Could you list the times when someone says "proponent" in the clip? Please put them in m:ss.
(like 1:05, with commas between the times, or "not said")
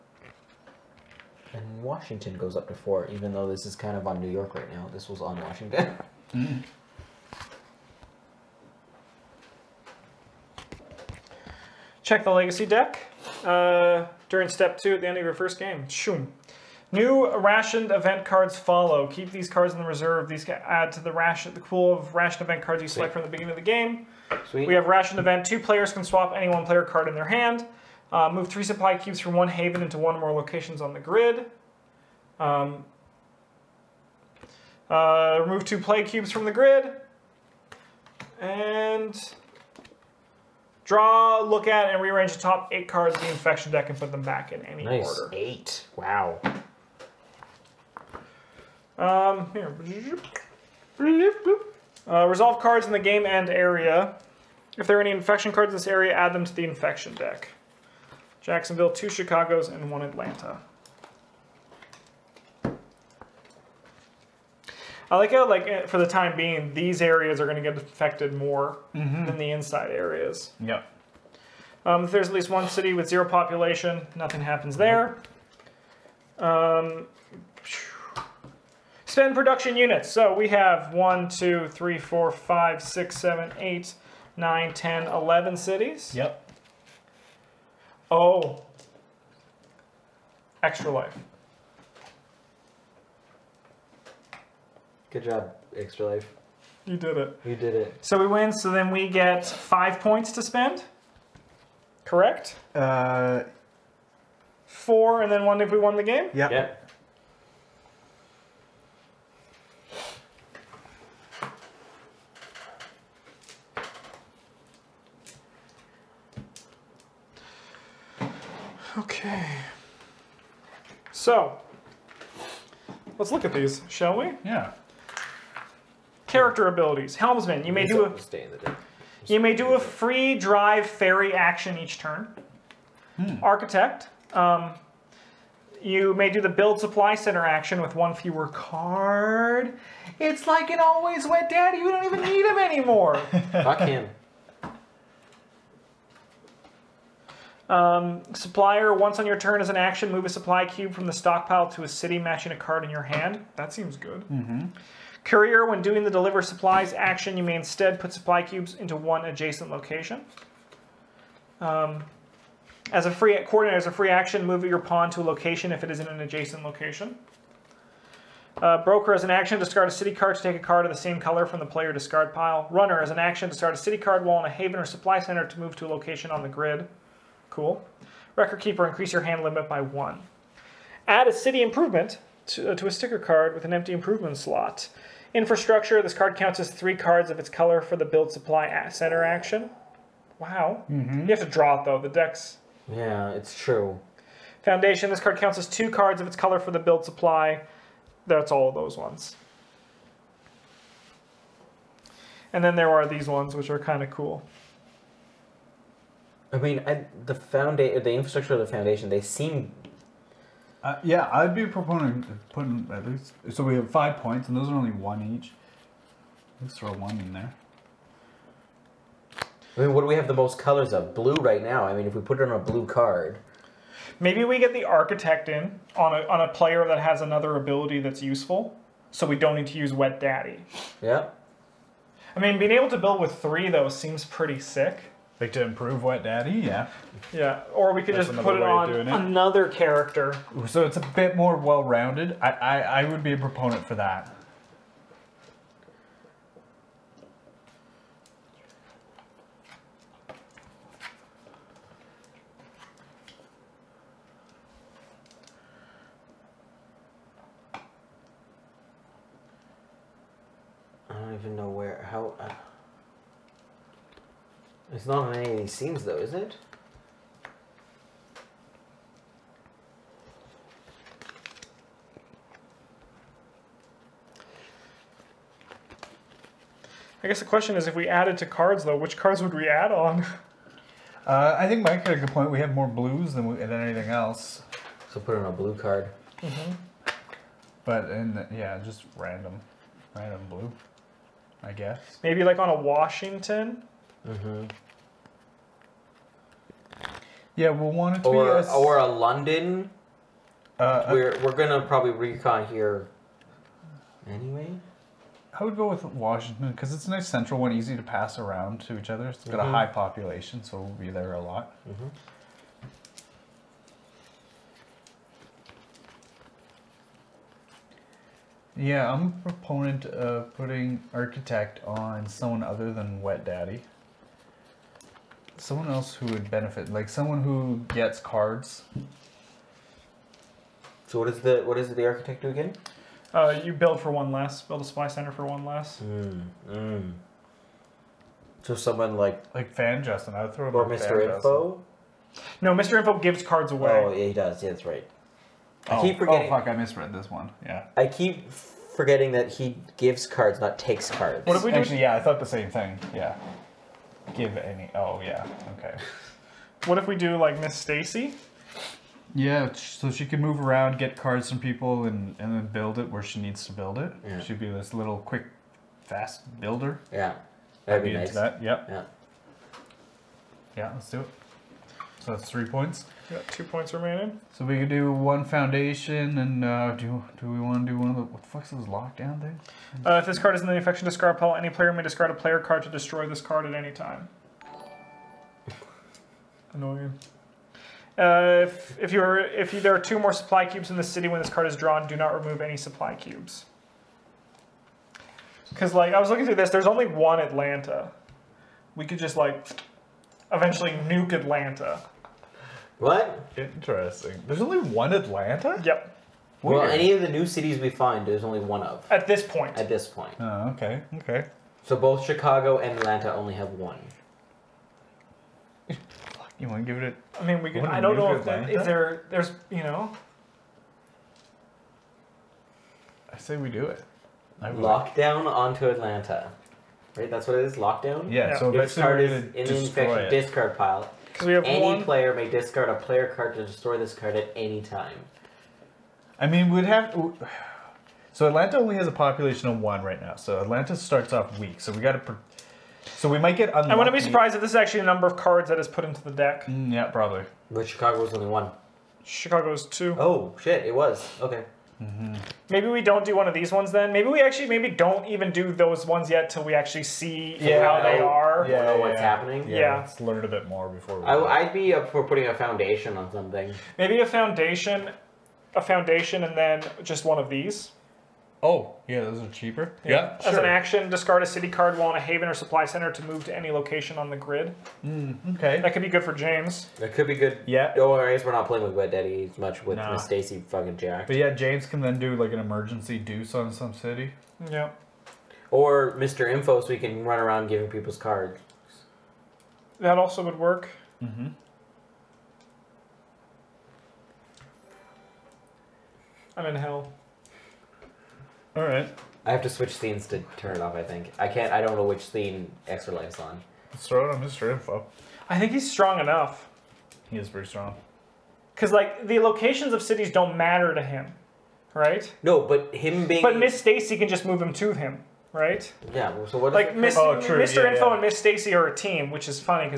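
3:31, 4:03, 5:19.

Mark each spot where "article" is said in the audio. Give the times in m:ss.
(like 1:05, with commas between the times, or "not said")
not said.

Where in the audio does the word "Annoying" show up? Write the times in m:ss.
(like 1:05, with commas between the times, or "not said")
6:26.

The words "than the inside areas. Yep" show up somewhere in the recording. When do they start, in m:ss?
1:09.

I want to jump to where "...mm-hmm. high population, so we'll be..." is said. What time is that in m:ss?
5:09.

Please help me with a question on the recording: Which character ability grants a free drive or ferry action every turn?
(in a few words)
Helmsman.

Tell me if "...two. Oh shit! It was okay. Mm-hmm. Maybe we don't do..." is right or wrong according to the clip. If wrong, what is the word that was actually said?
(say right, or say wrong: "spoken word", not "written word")
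right.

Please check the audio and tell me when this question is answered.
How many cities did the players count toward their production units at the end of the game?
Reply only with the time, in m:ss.
1:25.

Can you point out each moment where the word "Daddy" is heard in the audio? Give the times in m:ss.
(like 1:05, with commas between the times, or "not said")
2:21, 3:50, 3:56, 5:23, 7:59.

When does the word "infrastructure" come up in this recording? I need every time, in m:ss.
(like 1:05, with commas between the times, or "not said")
3:05, 3:28.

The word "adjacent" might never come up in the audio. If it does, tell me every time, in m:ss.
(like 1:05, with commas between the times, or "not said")
2:39, 2:46.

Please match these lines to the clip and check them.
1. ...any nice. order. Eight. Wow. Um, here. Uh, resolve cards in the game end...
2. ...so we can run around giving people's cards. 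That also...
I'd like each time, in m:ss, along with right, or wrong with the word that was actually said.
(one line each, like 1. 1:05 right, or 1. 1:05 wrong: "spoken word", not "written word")
1. 0:44 right
2. 8:06 right.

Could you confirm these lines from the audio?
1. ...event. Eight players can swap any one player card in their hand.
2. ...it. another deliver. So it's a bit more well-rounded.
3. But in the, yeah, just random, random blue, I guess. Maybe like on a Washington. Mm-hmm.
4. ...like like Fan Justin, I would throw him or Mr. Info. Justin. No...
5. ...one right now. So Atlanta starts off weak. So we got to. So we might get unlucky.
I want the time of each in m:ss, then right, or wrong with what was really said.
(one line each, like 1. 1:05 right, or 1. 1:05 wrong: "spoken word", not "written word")
1. 0:25 wrong: "Two", not "Eight"
2. 3:58 wrong: "character", not "deliver"
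3. 4:47 right
4. 5:39 right
5. 7:19 right.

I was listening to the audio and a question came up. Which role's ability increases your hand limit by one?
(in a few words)
Record Keeper.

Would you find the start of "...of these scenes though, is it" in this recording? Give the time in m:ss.
4:25.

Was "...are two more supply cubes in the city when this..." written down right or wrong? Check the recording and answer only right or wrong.
right.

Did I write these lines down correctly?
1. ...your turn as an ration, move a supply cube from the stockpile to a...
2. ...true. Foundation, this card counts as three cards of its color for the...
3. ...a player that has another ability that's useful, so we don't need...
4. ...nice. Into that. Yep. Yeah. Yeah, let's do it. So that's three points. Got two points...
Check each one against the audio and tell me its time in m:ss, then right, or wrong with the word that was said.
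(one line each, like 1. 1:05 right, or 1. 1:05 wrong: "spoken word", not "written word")
1. 2:29 wrong: "action", not "ration"
2. 3:13 wrong: "two", not "three"
3. 3:46 right
4. 6:08 right.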